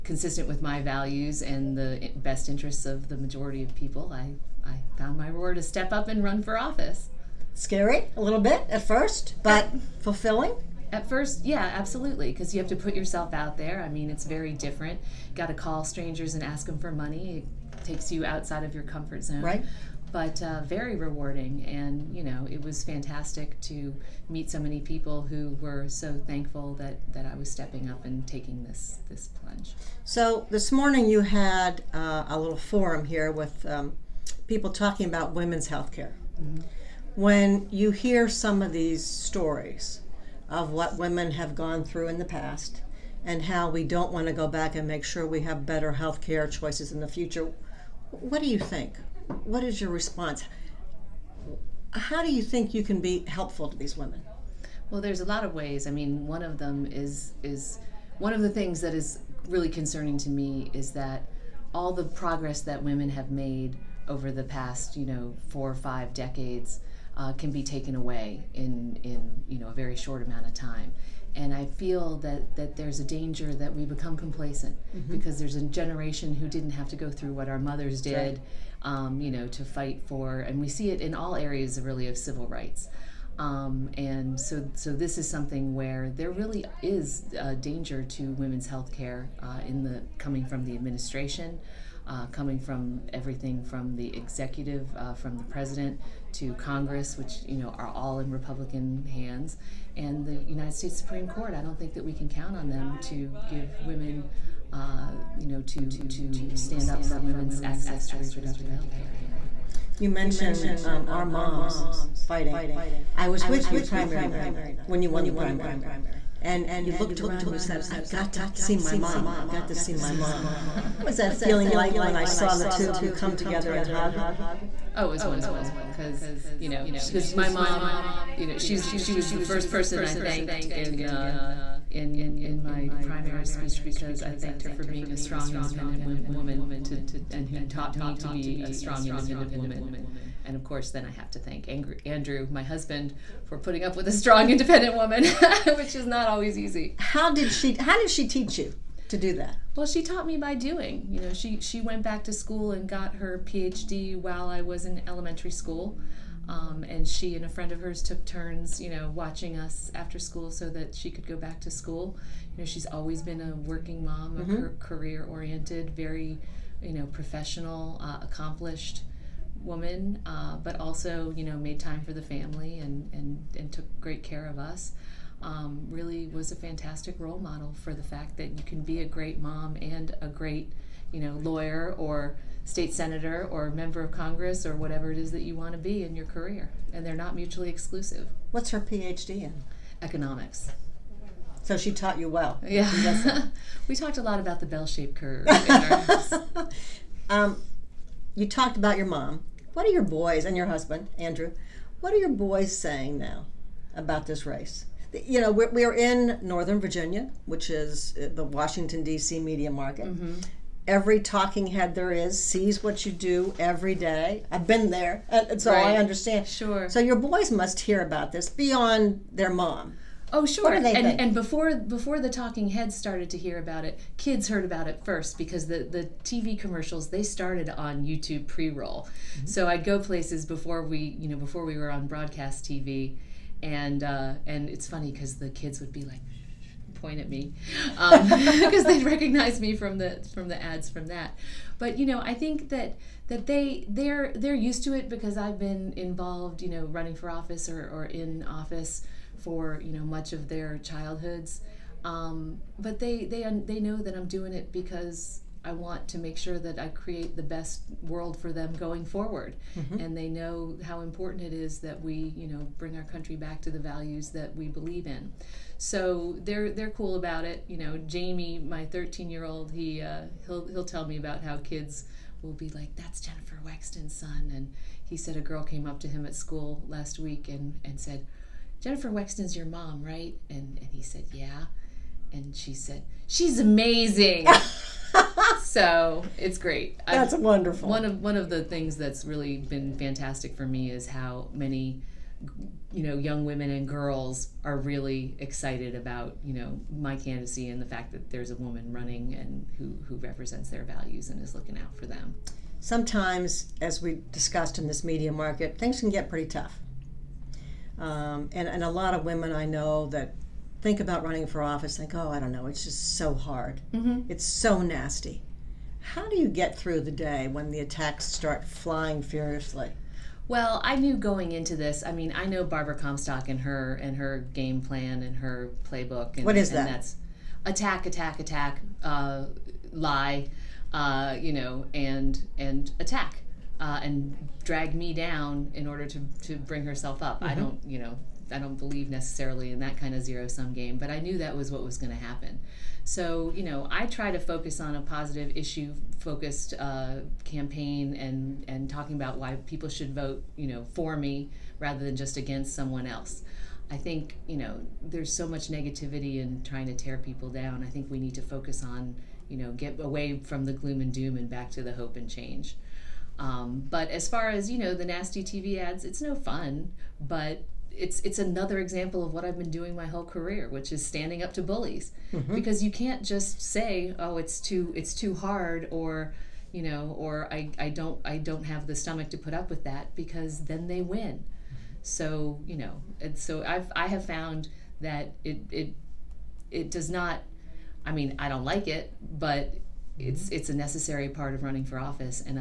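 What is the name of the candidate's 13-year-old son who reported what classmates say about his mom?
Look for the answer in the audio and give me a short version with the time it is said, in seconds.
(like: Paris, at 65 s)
Jamie, at 268 s.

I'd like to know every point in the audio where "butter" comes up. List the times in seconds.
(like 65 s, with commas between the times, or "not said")
not said.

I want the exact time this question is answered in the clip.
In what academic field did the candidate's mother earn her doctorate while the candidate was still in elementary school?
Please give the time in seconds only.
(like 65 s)
190 s.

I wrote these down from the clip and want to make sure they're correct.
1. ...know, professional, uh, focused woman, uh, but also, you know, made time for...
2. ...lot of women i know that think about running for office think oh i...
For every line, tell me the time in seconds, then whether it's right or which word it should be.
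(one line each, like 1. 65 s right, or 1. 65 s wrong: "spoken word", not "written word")
1. 166 s wrong: "accomplished", not "focused"
2. 308 s right.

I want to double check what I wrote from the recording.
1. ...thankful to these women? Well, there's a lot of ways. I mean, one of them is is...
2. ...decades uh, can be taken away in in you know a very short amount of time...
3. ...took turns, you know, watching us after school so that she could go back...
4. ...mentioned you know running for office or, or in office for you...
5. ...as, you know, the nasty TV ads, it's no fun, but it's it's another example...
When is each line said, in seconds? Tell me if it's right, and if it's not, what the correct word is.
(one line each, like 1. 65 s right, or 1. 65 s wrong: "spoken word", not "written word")
1. 53 s wrong: "helpful", not "thankful"
2. 66 s right
3. 158 s right
4. 245 s wrong: "involved", not "mentioned"
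5. 364 s right.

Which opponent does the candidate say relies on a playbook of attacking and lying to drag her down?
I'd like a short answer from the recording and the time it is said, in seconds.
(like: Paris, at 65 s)
Barbara Comstock, at 322 s.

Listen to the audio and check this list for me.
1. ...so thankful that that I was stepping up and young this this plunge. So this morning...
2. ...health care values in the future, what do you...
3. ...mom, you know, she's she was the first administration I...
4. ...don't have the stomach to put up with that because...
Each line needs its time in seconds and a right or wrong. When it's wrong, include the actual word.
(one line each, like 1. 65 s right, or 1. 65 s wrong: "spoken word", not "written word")
1. 25 s wrong: "taking", not "young"
2. 45 s wrong: "choices", not "values"
3. 127 s wrong: "person", not "administration"
4. 378 s right.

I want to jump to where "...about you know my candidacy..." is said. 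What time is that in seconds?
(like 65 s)
295 s.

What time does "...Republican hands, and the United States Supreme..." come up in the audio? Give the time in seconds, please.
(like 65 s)
98 s.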